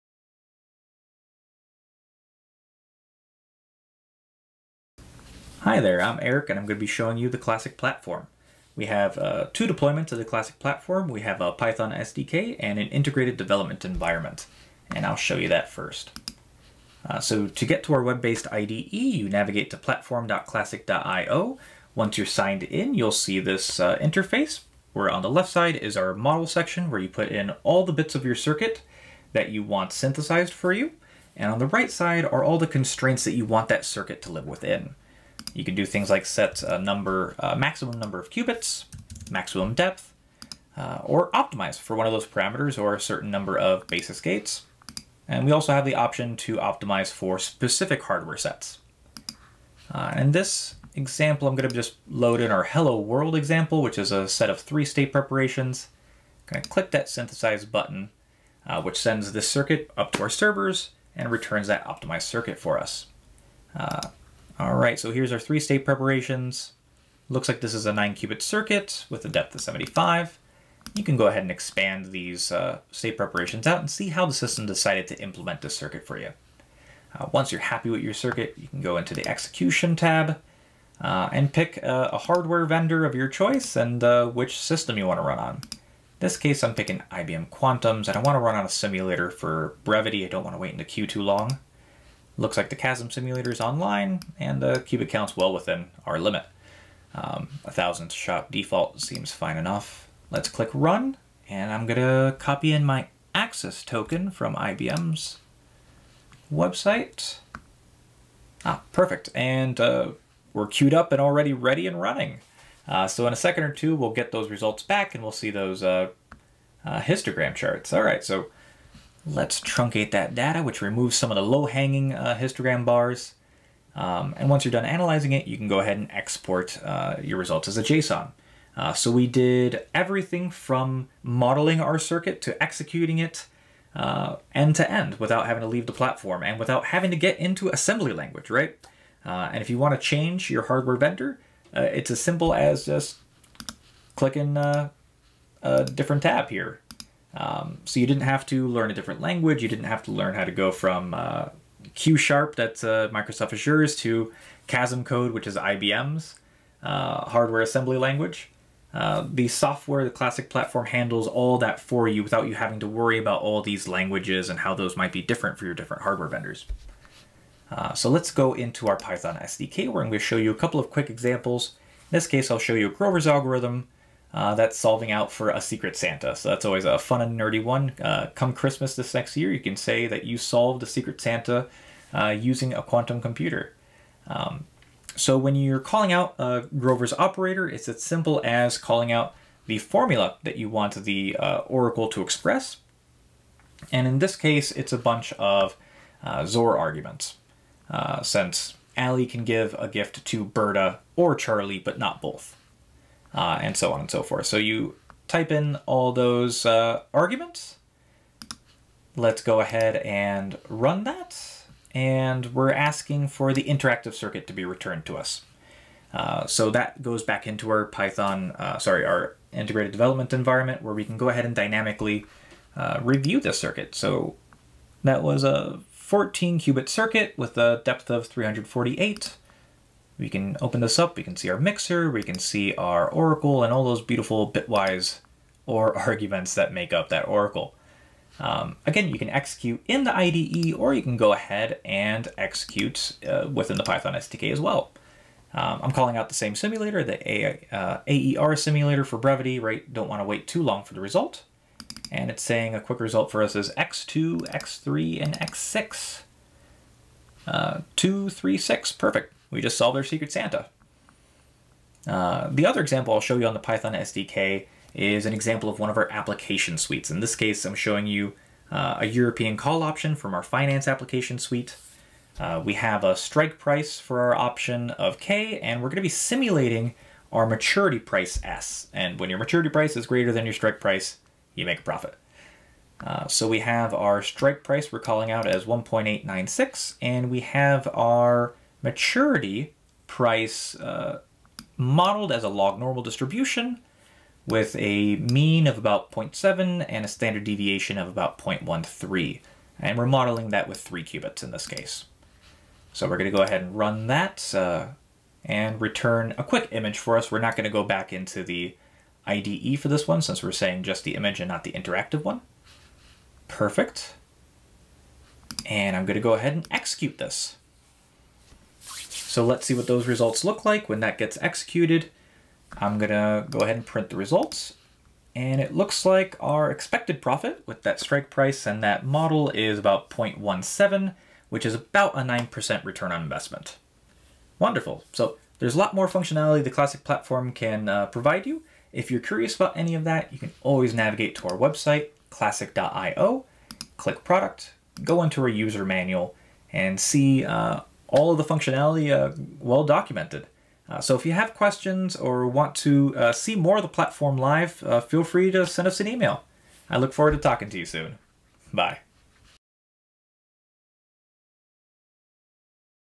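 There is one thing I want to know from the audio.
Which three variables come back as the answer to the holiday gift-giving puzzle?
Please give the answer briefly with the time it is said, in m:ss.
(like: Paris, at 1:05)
X2, X3, and X6, at 4:13.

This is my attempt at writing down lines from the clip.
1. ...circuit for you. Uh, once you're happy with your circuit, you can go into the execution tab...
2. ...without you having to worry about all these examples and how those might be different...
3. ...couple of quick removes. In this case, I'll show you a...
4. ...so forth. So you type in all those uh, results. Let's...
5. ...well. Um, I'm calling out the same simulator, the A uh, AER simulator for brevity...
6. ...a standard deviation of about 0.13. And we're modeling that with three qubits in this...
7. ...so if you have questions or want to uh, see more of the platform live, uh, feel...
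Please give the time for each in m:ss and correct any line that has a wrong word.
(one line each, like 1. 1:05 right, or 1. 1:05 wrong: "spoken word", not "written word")
1. 1:15 right
2. 2:42 wrong: "languages", not "examples"
3. 2:50 wrong: "examples", not "removes"
4. 3:24 wrong: "arguments", not "results"
5. 4:04 right
6. 4:57 right
7. 5:50 right.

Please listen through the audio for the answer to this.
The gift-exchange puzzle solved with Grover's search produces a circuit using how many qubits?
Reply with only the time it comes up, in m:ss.
3:45.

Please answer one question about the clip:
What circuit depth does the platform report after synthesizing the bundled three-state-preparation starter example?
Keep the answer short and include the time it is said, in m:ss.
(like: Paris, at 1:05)
75, at 1:09.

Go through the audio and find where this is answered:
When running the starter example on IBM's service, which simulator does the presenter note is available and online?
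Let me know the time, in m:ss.
1:32.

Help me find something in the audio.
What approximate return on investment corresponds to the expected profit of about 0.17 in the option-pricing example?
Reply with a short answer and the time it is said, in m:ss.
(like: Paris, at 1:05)
9%, at 5:32.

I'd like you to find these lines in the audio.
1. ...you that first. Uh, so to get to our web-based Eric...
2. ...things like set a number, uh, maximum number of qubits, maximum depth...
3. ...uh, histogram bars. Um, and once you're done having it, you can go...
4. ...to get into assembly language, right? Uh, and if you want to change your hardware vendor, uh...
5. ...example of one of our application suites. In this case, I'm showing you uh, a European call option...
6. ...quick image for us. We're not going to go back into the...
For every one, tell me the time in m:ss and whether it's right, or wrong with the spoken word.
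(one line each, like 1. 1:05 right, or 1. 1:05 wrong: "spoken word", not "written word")
1. 0:15 wrong: "IDE", not "Eric"
2. 0:35 right
3. 2:02 wrong: "analyzing", not "having"
4. 2:17 right
5. 4:25 right
6. 5:06 right.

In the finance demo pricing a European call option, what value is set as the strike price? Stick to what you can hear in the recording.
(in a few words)
1.896.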